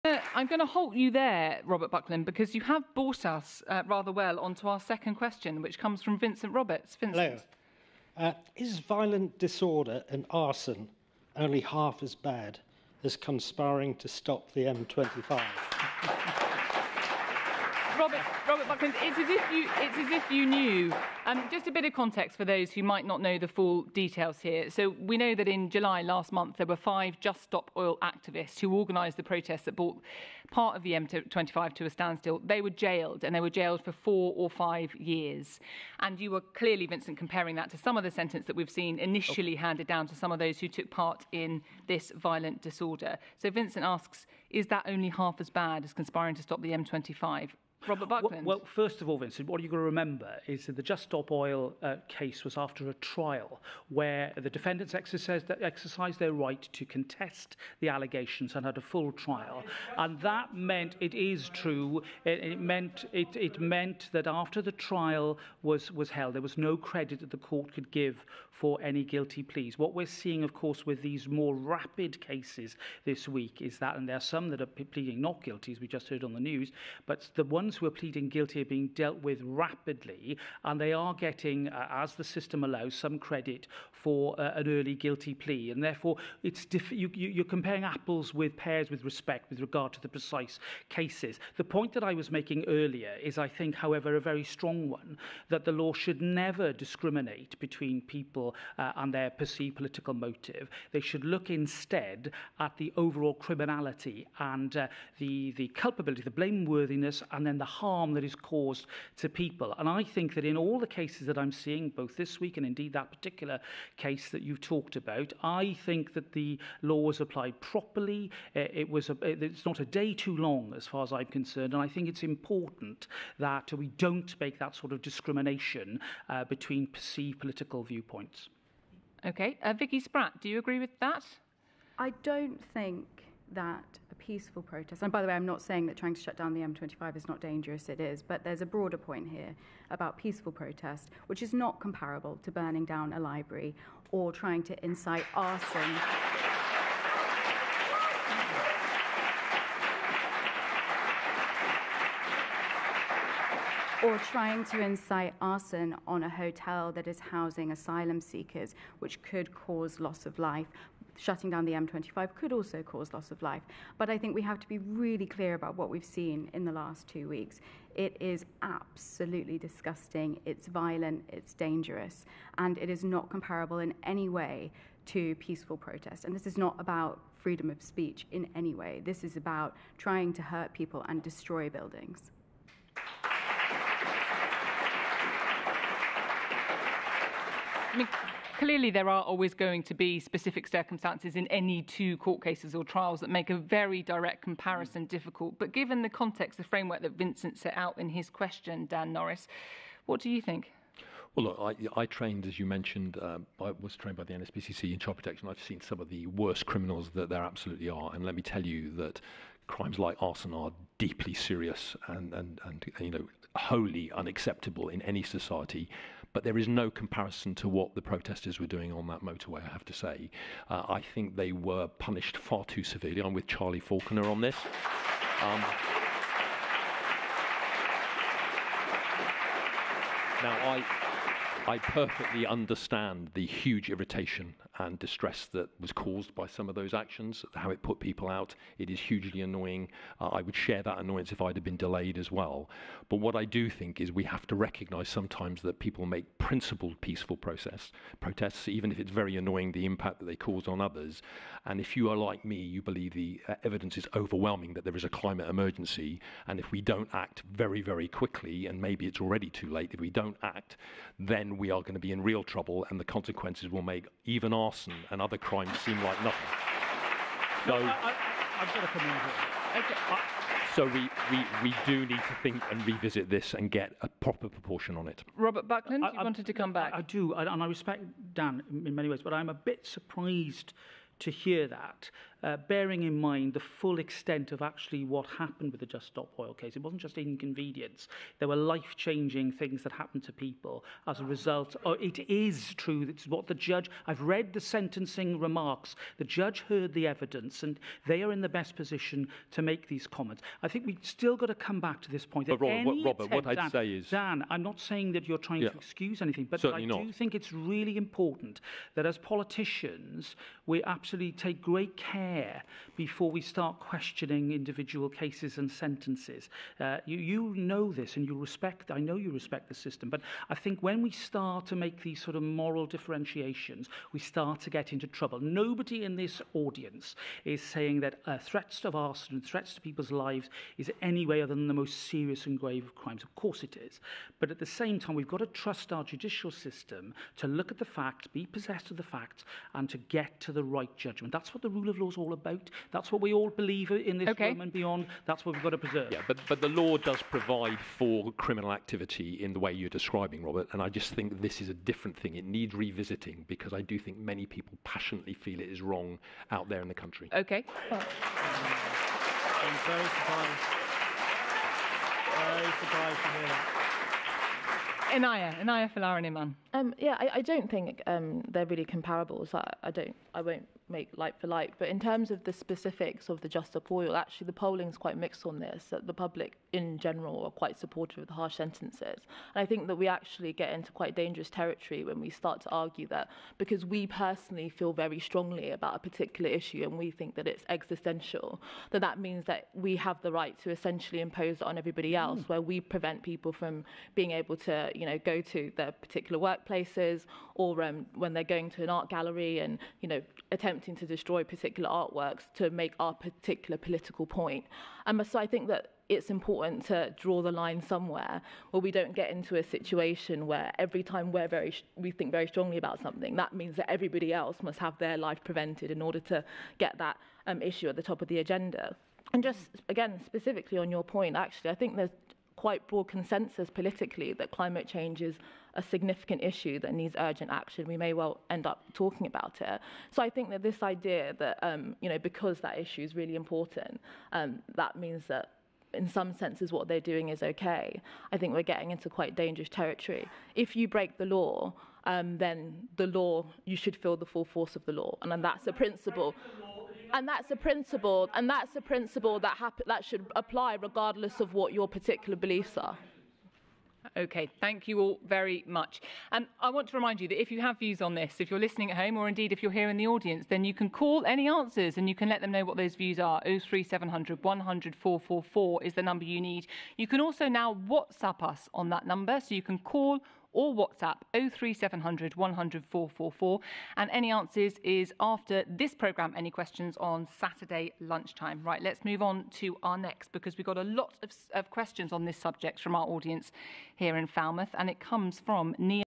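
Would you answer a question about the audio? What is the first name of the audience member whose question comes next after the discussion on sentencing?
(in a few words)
Neil.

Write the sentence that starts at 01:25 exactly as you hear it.
And therefore, it's diff- you, you, you're comparing apples with pears with respect with regard to the precise cases.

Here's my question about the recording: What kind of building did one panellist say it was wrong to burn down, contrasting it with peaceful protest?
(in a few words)
A library.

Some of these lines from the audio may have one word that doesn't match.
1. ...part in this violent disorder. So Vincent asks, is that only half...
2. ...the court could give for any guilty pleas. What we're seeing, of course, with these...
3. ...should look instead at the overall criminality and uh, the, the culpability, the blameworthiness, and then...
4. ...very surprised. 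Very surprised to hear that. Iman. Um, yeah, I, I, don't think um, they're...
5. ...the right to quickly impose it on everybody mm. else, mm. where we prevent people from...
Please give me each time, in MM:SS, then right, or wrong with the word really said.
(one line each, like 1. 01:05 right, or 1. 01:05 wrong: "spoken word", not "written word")
1. 00:40 right
2. 01:07 right
3. 01:40 right
4. 05:59 right
5. 06:30 wrong: "essentially", not "quickly".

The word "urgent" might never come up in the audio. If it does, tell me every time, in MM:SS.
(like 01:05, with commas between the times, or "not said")
07:07.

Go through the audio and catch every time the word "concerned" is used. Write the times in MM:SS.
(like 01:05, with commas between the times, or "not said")
02:01.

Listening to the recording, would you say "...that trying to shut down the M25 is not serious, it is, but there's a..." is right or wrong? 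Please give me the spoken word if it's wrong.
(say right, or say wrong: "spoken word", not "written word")
wrong: "dangerous", not "serious".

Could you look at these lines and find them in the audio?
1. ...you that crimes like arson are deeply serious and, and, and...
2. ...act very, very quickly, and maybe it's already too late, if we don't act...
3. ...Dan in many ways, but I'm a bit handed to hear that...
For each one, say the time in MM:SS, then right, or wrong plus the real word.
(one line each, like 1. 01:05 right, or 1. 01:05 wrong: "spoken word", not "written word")
1. 03:28 right
2. 04:17 right
3. 04:38 wrong: "surprised", not "handed".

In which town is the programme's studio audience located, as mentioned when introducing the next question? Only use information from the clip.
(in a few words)
Falmouth.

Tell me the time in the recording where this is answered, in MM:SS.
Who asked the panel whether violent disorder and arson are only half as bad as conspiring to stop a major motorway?
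00:06.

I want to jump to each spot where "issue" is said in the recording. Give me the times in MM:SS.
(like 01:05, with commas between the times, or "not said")
06:26, 06:57, 07:06, 07:12.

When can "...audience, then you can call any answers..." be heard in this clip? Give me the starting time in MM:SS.
07:40.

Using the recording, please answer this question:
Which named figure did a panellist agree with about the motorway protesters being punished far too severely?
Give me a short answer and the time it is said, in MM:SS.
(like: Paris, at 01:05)
Charlie Falconer, at 03:43.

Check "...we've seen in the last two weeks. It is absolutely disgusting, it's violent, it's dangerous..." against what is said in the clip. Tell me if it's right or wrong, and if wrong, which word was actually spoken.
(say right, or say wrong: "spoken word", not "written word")
right.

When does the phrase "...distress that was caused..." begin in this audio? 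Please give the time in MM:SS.
03:54.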